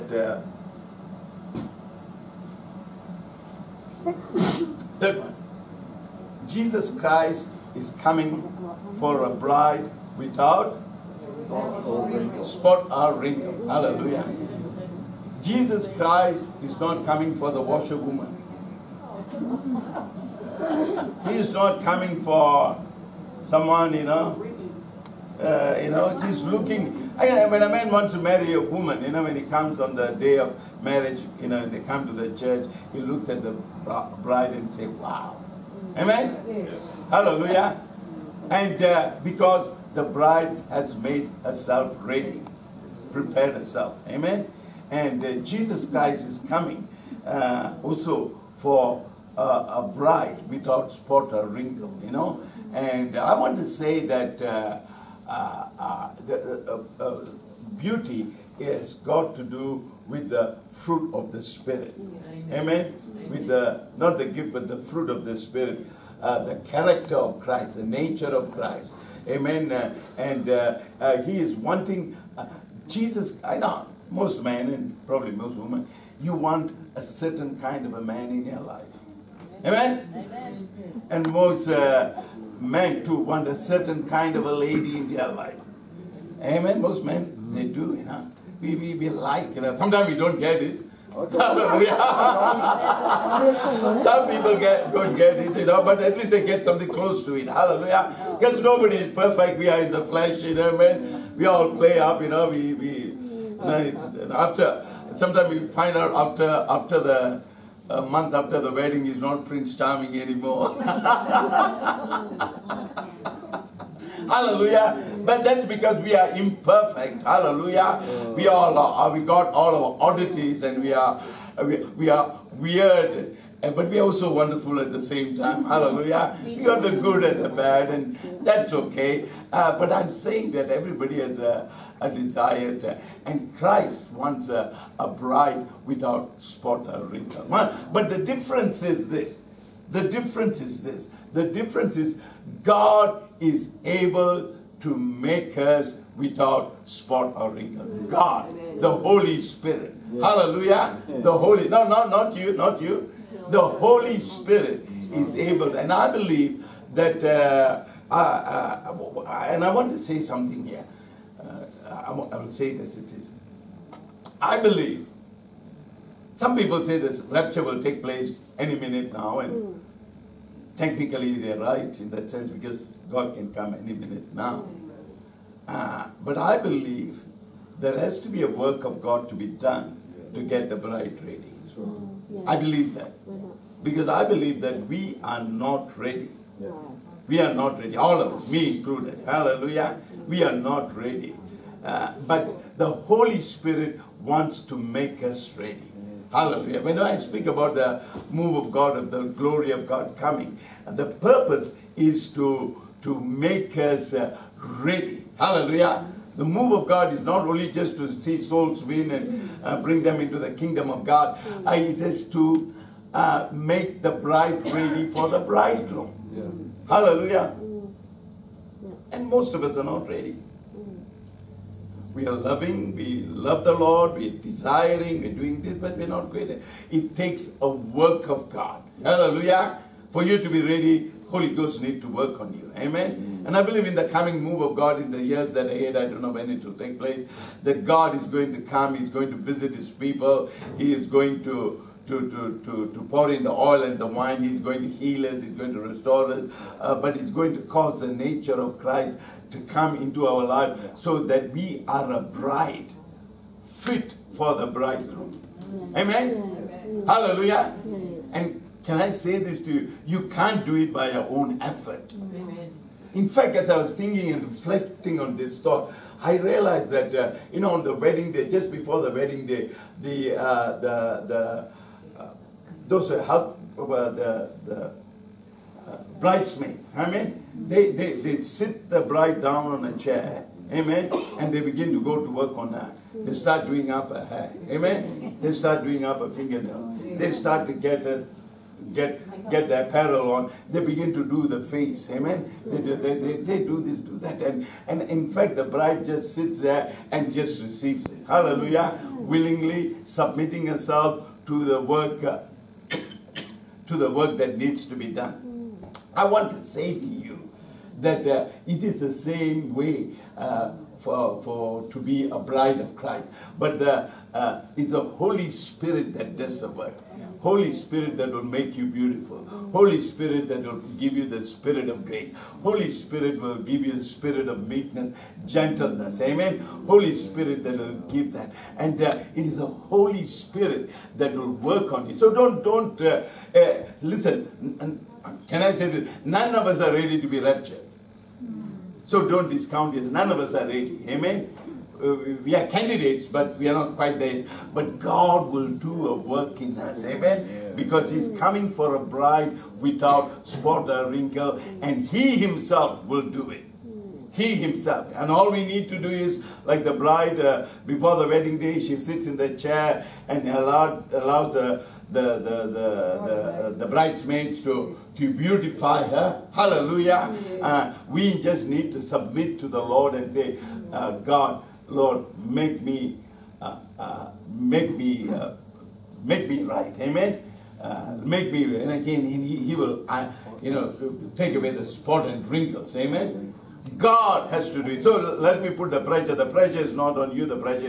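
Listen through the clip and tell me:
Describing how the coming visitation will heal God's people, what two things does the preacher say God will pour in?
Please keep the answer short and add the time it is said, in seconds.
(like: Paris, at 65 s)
The oil and the wine, at 243 s.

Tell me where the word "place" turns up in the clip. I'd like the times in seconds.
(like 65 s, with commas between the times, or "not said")
168 s, 237 s.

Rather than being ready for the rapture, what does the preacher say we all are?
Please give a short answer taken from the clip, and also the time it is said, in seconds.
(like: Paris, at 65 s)
Candidates, at 342 s.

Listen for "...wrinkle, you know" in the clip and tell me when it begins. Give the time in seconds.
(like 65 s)
51 s.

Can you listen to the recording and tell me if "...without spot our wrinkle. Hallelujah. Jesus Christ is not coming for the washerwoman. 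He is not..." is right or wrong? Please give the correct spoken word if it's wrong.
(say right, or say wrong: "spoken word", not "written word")
right.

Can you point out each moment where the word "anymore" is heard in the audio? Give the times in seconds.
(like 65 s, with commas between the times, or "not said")
110 s.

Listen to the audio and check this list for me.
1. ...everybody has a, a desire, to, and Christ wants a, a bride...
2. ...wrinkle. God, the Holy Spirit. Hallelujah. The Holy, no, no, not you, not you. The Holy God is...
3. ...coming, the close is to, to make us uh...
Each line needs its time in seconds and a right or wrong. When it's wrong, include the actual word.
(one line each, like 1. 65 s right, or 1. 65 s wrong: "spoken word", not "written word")
1. 130 s right
2. 147 s wrong: "Spirit", not "God"
3. 200 s wrong: "purpose", not "close".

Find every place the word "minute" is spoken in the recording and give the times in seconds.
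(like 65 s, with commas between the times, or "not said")
168 s, 173 s.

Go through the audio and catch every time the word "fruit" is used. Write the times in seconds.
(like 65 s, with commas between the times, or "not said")
60 s, 64 s.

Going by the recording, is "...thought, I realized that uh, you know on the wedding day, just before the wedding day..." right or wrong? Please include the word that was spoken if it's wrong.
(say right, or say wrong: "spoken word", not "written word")
right.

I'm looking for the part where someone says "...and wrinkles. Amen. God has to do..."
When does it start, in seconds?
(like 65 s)
382 s.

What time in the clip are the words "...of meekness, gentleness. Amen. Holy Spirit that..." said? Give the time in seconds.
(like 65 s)
324 s.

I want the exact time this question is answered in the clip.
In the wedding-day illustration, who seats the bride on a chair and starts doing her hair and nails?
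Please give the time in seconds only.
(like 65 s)
276 s.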